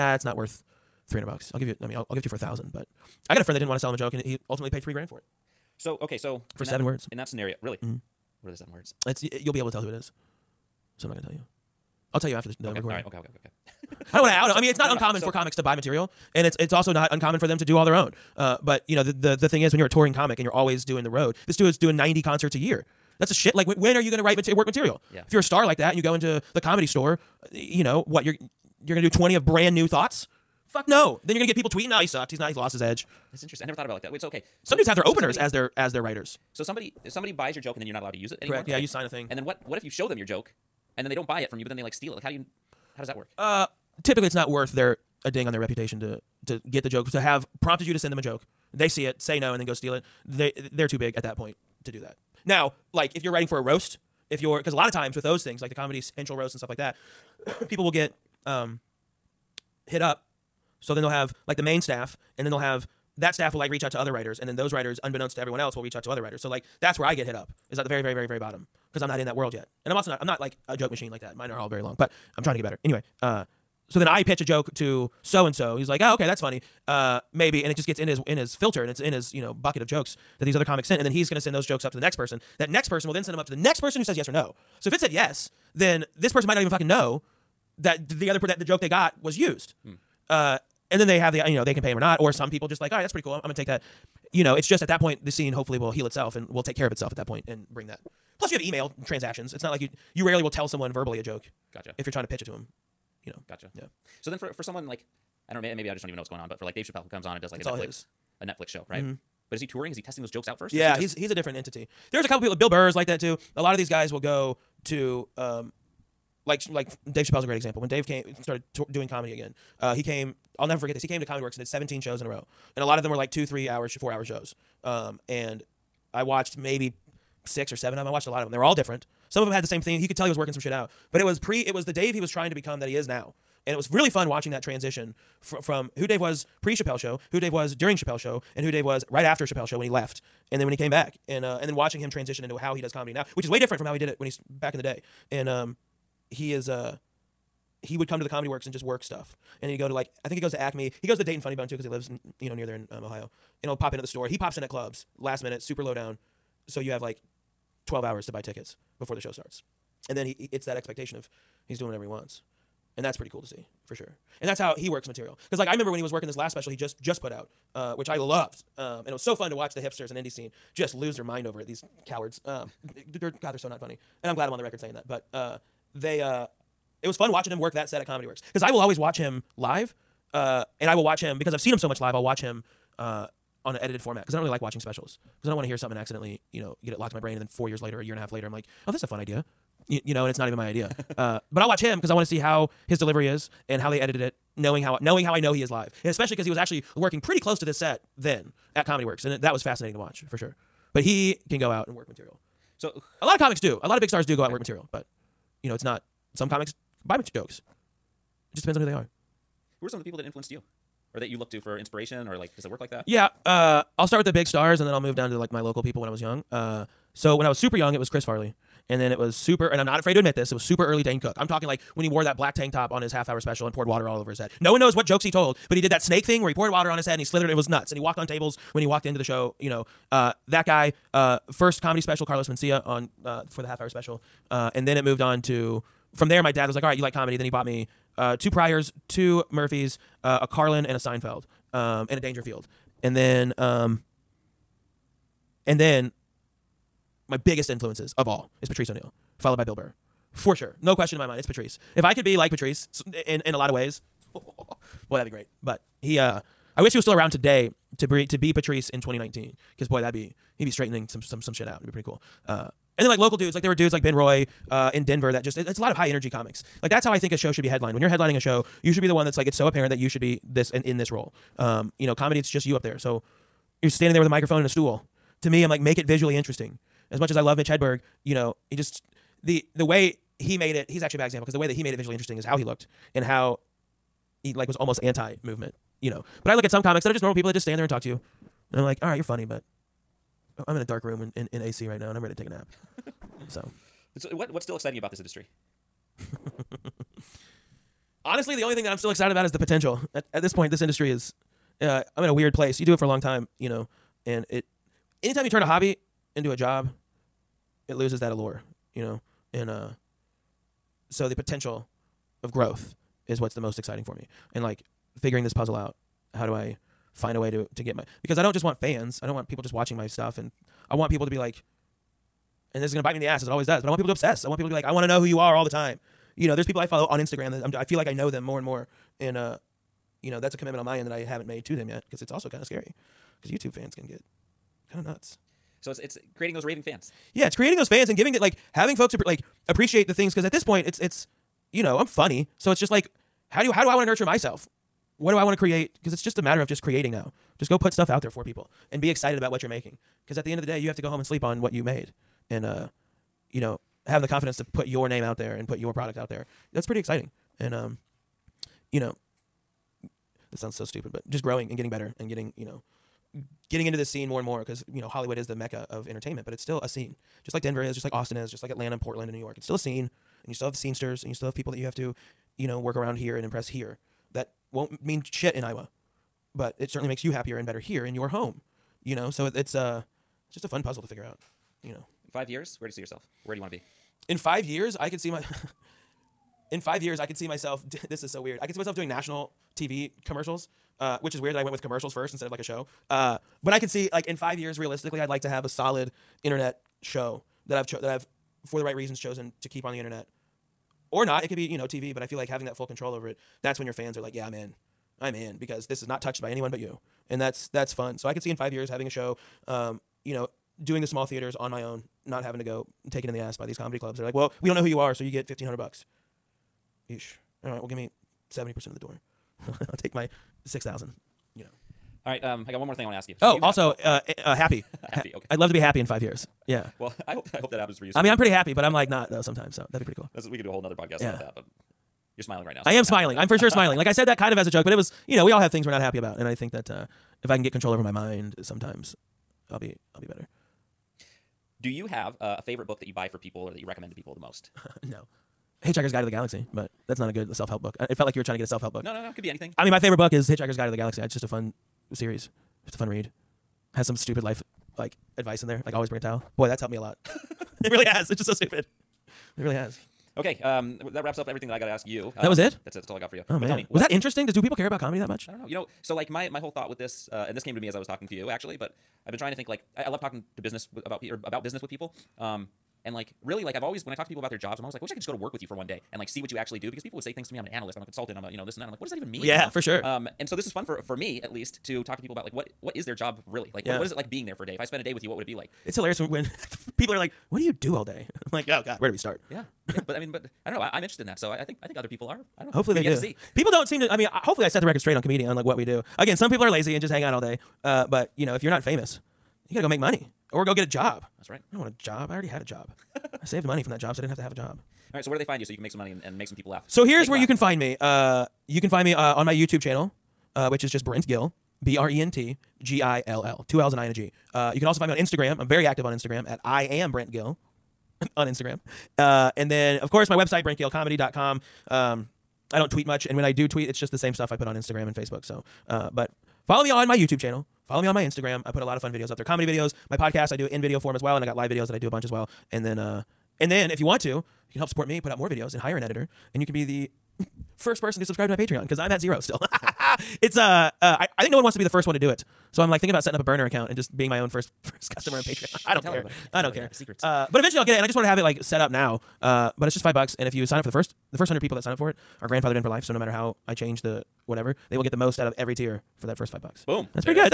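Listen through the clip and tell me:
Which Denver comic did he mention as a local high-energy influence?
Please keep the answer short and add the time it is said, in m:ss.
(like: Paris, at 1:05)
Ben Roy, at 4:24.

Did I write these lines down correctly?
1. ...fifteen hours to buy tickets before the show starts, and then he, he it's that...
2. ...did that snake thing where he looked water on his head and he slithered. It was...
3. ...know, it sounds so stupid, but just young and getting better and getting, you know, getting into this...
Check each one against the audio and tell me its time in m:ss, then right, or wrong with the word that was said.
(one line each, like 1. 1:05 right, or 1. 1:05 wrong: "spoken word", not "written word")
1. 2:37 wrong: "twelve", not "fifteen"
2. 3:45 wrong: "poured", not "looked"
3. 5:58 wrong: "growing", not "young".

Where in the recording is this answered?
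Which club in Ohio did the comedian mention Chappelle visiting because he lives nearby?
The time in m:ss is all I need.
2:31.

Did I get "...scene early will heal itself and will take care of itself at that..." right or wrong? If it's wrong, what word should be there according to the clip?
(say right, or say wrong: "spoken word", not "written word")
wrong: "hopefully", not "early".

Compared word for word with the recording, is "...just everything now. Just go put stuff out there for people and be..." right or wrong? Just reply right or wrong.
wrong.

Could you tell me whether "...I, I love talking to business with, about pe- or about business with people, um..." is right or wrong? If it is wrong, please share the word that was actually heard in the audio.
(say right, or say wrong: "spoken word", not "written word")
right.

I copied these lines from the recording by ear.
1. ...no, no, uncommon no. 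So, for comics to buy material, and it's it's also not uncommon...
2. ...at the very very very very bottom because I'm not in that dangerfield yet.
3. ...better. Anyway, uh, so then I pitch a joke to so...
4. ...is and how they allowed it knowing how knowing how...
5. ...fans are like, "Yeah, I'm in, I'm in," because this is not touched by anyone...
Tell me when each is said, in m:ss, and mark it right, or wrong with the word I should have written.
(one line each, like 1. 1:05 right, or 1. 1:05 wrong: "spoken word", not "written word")
1. 0:14 right
2. 1:07 wrong: "world", not "dangerfield"
3. 1:12 right
4. 3:13 wrong: "edited", not "allowed"
5. 6:43 right.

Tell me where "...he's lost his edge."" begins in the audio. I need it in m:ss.
0:32.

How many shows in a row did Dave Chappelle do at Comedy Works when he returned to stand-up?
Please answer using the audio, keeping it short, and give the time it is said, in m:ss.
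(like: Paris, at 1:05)
17, at 2:01.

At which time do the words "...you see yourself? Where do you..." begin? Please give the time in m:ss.
6:22.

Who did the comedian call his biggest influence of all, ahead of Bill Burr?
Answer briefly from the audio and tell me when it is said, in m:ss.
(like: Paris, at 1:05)
Patrice O'Neal, at 4:08.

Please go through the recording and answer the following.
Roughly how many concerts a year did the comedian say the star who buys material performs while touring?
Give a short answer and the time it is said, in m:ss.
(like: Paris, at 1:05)
90, at 0:21.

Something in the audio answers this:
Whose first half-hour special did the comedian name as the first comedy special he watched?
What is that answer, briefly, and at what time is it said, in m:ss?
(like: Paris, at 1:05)
Carlos Mencia, at 3:52.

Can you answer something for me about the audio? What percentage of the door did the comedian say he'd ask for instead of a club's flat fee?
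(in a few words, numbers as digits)
70%.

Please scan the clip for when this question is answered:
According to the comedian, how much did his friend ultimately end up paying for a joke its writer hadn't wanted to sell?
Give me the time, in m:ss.
0:04.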